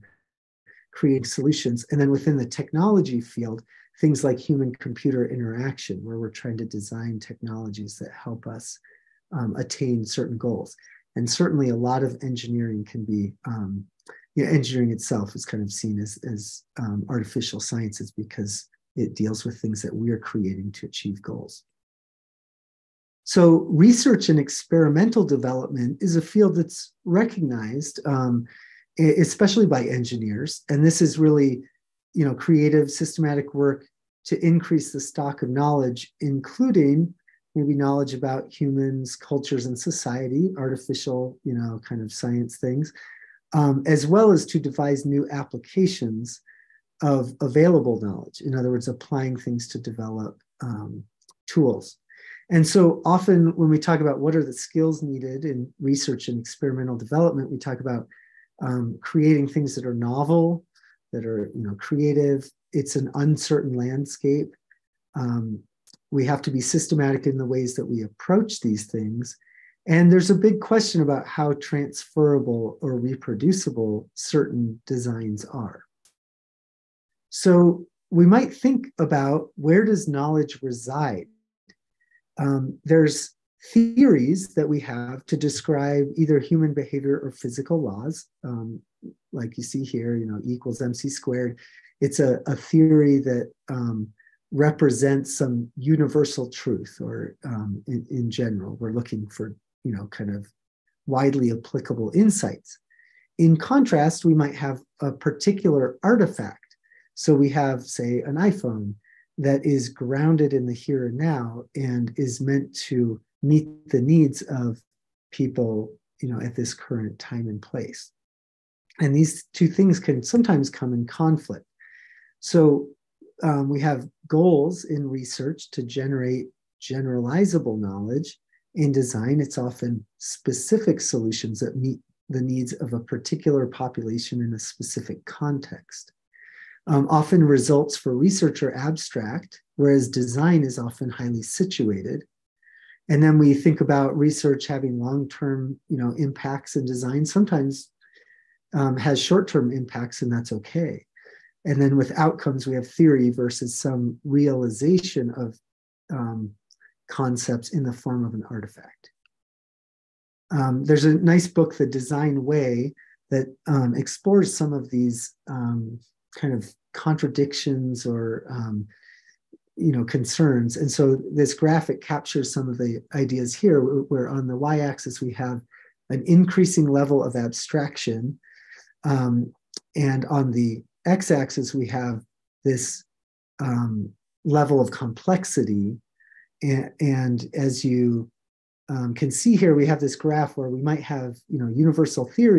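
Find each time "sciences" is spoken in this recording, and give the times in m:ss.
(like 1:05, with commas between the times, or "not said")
0:17, 0:42.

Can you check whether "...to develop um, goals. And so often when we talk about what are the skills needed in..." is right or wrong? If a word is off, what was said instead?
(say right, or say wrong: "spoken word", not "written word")
wrong: "tools", not "goals".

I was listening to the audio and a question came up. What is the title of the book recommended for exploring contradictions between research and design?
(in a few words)
The Design Way.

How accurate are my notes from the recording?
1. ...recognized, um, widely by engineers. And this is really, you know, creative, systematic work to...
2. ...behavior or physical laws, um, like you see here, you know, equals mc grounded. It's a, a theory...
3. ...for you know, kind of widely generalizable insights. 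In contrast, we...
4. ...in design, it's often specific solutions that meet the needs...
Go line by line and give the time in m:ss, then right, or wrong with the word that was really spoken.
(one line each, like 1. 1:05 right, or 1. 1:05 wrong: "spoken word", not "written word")
1. 0:27 wrong: "especially", not "widely"
2. 1:26 wrong: "squared", not "grounded"
3. 1:39 wrong: "applicable", not "generalizable"
4. 2:08 right.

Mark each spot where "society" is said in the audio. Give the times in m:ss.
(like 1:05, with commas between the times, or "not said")
0:39.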